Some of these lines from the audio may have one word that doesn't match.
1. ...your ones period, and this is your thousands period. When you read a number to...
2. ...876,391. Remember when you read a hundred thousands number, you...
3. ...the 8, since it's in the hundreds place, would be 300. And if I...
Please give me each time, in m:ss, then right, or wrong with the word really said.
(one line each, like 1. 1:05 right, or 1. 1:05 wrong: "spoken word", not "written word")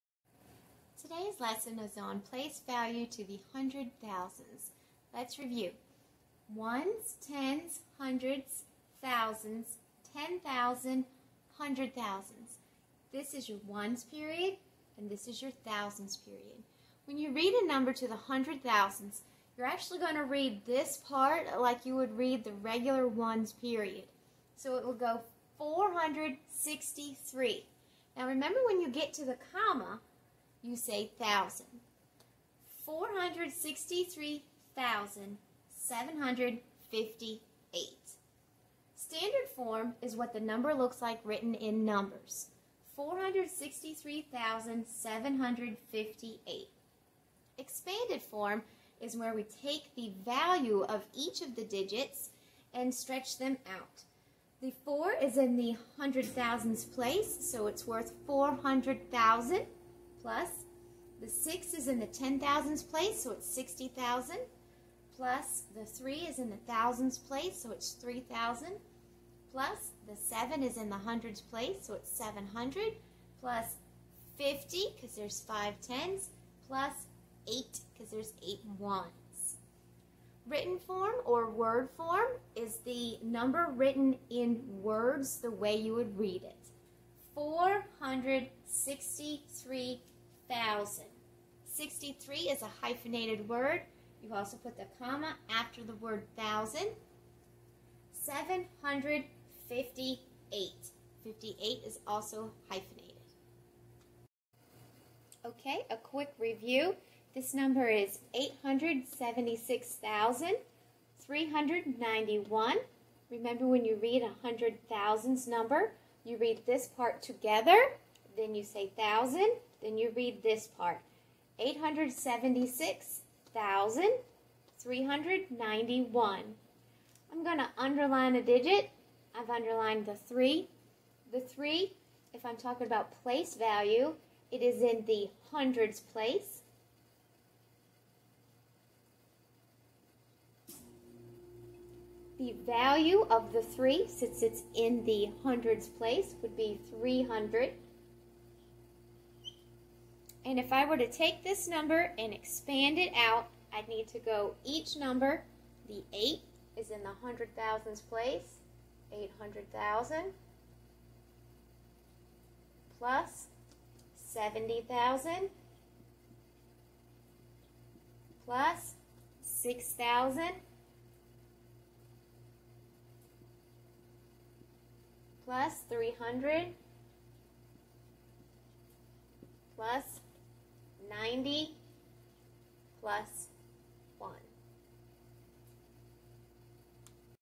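1. 0:13 right
2. 1:48 right
3. 2:23 wrong: "3", not "8".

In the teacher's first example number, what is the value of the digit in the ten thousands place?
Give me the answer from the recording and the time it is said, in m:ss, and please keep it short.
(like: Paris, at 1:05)
60,000, at 1:03.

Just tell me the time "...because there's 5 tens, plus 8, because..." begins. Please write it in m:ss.
1:14.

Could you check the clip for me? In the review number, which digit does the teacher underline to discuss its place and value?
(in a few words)
3.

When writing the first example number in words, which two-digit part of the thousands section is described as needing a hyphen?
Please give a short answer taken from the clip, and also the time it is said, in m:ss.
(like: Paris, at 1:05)
63, at 1:31.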